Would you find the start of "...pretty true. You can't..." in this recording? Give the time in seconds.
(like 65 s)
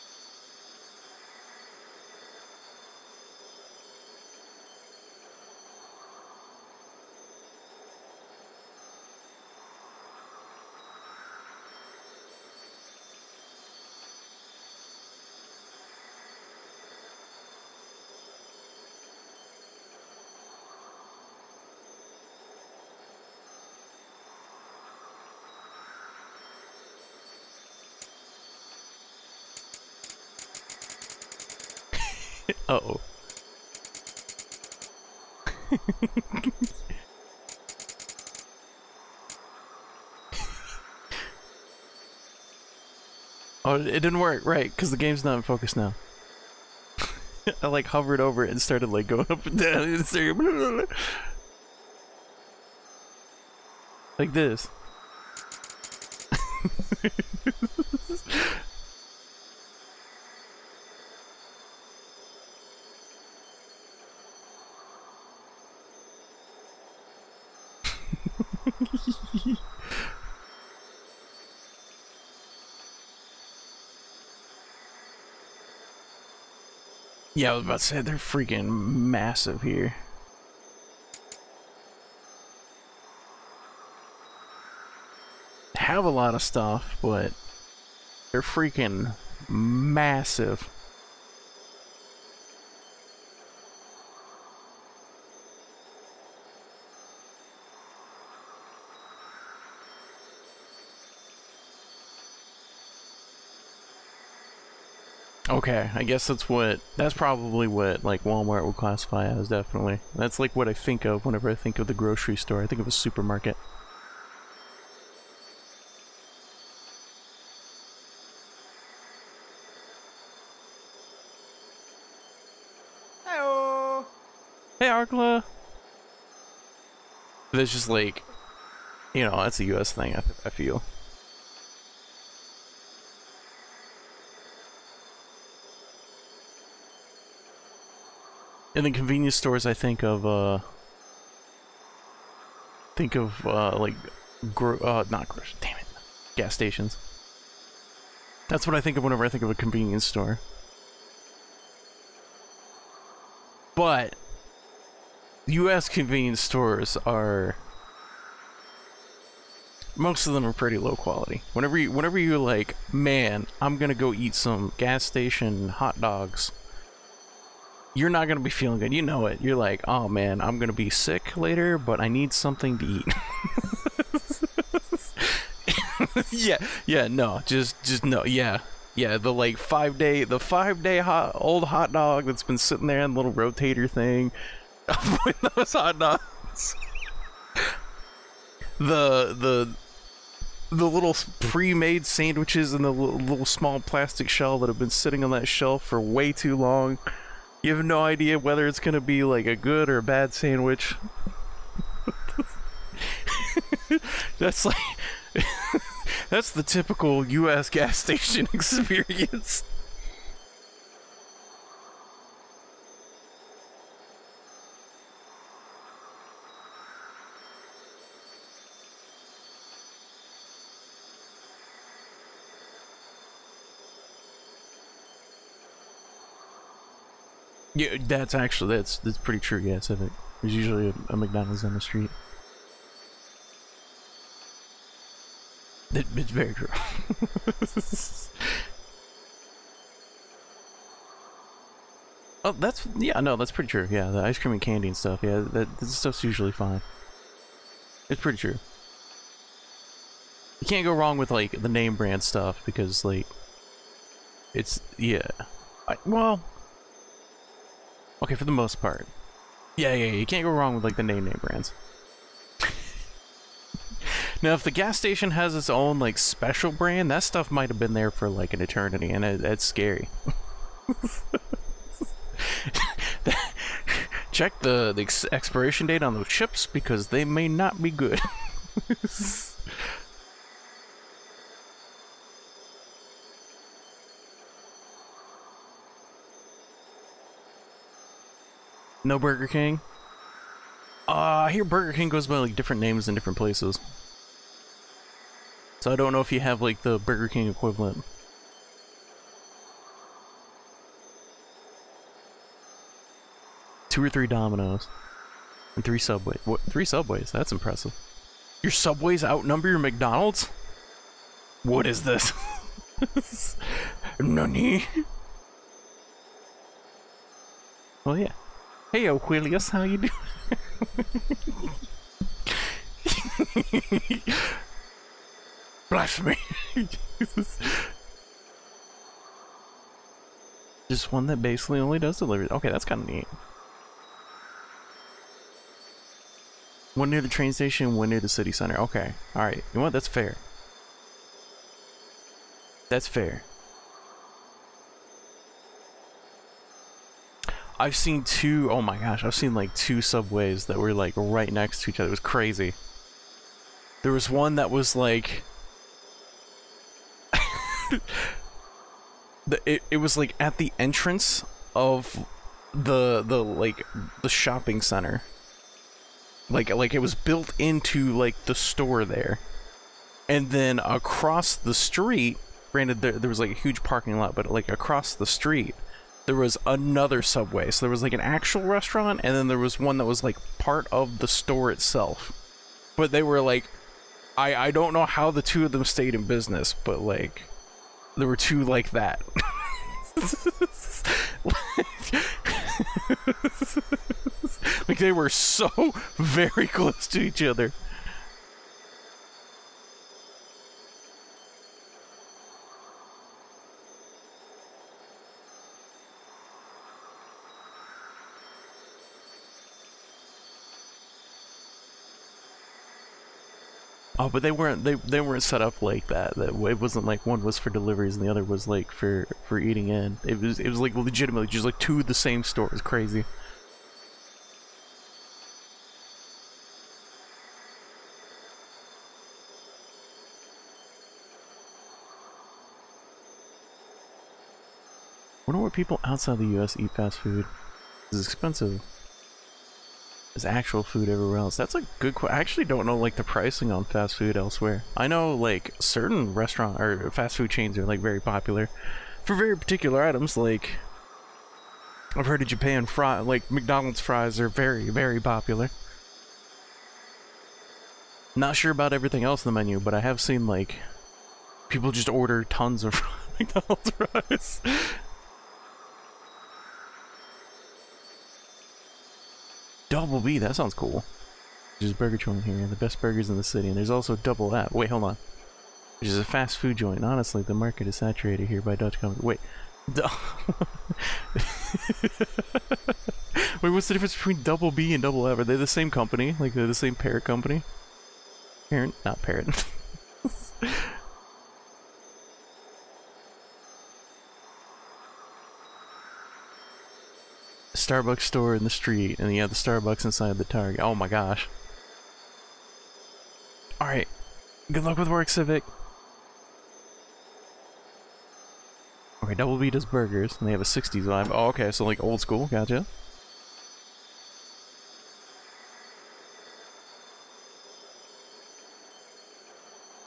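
248 s.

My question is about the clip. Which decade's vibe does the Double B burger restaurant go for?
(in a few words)
60s.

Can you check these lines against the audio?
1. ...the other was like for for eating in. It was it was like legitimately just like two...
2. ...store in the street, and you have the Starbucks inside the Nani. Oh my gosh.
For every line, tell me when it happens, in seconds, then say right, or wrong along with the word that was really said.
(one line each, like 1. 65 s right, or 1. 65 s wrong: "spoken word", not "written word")
1. 418 s right
2. 498 s wrong: "Target", not "Nani".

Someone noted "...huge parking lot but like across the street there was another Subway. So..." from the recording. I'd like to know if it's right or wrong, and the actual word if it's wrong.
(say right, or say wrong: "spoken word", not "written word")
right.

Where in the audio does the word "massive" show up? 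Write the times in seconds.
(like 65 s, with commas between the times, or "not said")
78 s, 89 s.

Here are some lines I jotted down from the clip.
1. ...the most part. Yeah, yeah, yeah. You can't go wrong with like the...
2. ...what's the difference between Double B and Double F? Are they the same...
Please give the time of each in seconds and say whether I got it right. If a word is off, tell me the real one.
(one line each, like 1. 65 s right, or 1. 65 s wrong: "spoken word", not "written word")
1. 258 s right
2. 483 s right.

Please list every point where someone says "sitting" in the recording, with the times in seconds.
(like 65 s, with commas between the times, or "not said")
182 s, 194 s.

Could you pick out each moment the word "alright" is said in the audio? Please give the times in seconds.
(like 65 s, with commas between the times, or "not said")
339 s, 503 s.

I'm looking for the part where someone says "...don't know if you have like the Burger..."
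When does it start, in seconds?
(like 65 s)
295 s.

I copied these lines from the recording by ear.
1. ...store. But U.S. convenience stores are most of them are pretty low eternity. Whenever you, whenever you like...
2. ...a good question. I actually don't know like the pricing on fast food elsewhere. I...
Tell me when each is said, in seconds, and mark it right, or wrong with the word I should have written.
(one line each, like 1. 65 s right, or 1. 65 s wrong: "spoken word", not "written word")
1. 150 s wrong: "quality", not "eternity"
2. 441 s right.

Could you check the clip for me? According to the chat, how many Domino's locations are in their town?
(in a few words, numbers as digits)
2 or 3.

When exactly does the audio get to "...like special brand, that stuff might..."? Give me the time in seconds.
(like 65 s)
265 s.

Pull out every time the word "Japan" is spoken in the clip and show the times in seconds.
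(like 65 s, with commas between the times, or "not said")
452 s.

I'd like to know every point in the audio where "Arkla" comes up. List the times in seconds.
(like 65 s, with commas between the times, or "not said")
124 s.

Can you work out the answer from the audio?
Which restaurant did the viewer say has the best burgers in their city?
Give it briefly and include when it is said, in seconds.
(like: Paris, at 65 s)
Burger Joint, at 471 s.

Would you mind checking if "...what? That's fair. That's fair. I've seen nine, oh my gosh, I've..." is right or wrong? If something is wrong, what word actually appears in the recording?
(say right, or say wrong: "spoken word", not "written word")
wrong: "two", not "nine".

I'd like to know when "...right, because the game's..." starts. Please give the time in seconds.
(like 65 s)
44 s.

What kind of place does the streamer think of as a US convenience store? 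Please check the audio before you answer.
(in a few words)
Gas stations.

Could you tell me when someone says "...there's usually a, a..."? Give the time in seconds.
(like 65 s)
230 s.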